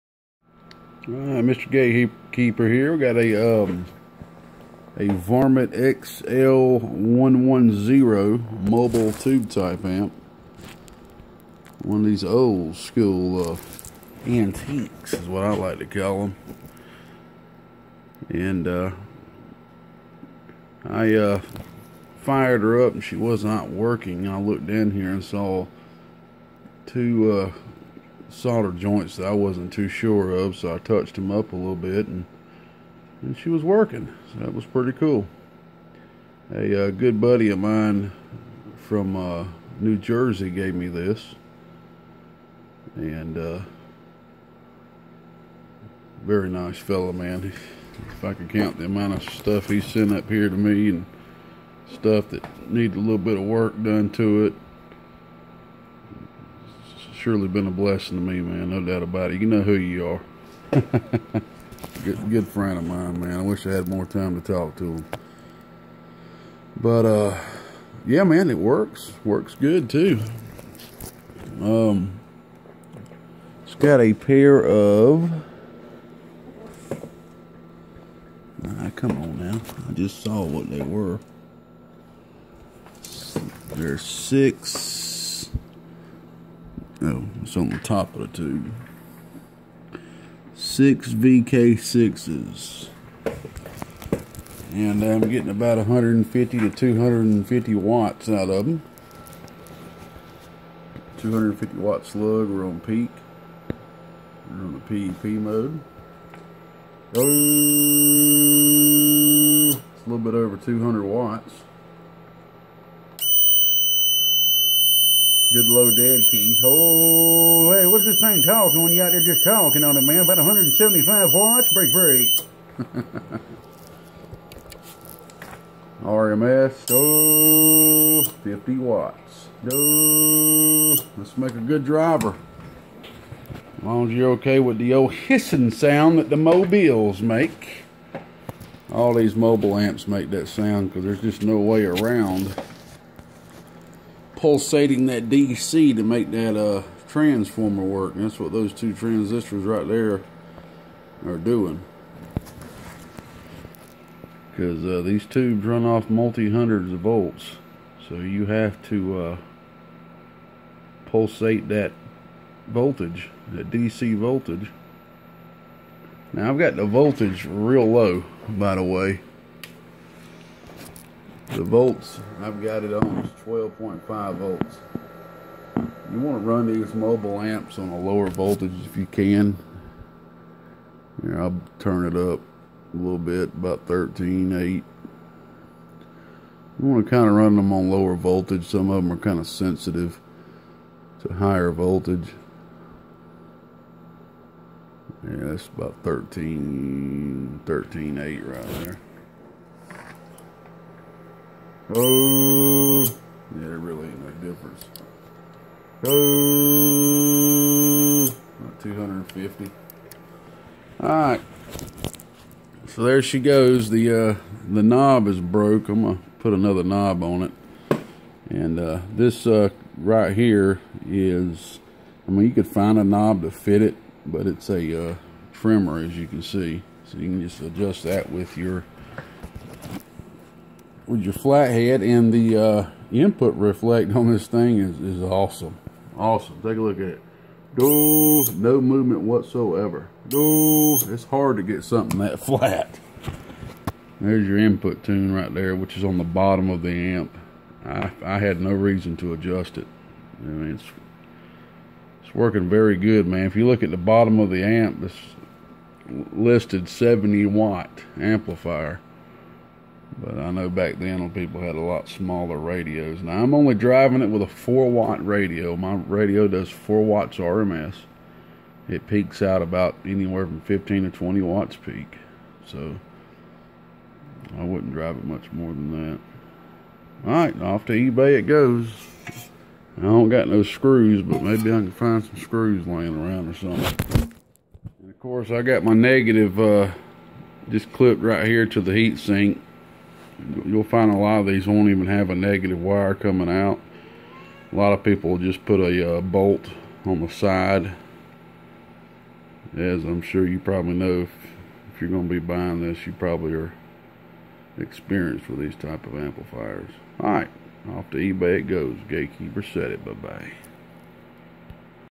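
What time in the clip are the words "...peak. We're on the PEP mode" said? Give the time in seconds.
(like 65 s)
102 s.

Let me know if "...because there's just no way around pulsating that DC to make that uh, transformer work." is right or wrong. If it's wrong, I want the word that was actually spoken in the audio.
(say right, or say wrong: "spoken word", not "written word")
right.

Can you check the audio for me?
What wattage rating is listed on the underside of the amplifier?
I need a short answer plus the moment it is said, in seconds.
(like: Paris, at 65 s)
70 watt, at 256 s.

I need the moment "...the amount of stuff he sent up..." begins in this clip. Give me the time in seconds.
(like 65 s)
48 s.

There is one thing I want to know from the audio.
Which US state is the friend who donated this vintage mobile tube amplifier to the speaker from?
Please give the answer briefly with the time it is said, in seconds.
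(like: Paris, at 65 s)
New Jersey, at 39 s.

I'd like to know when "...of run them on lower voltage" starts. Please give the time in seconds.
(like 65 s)
187 s.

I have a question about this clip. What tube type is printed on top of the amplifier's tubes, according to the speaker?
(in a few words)
6VK6.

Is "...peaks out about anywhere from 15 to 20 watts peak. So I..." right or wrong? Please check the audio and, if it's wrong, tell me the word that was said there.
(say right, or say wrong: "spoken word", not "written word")
right.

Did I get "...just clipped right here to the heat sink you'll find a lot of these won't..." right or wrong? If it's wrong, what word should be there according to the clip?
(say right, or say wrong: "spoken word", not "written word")
right.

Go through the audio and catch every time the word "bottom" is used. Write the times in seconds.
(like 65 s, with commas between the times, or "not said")
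246 s, 253 s.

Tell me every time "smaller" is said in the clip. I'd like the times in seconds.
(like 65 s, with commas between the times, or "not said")
262 s.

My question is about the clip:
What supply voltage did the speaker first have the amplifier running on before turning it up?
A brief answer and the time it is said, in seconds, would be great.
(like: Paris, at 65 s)
12.5 volts, at 173 s.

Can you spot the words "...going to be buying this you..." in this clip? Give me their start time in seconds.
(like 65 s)
302 s.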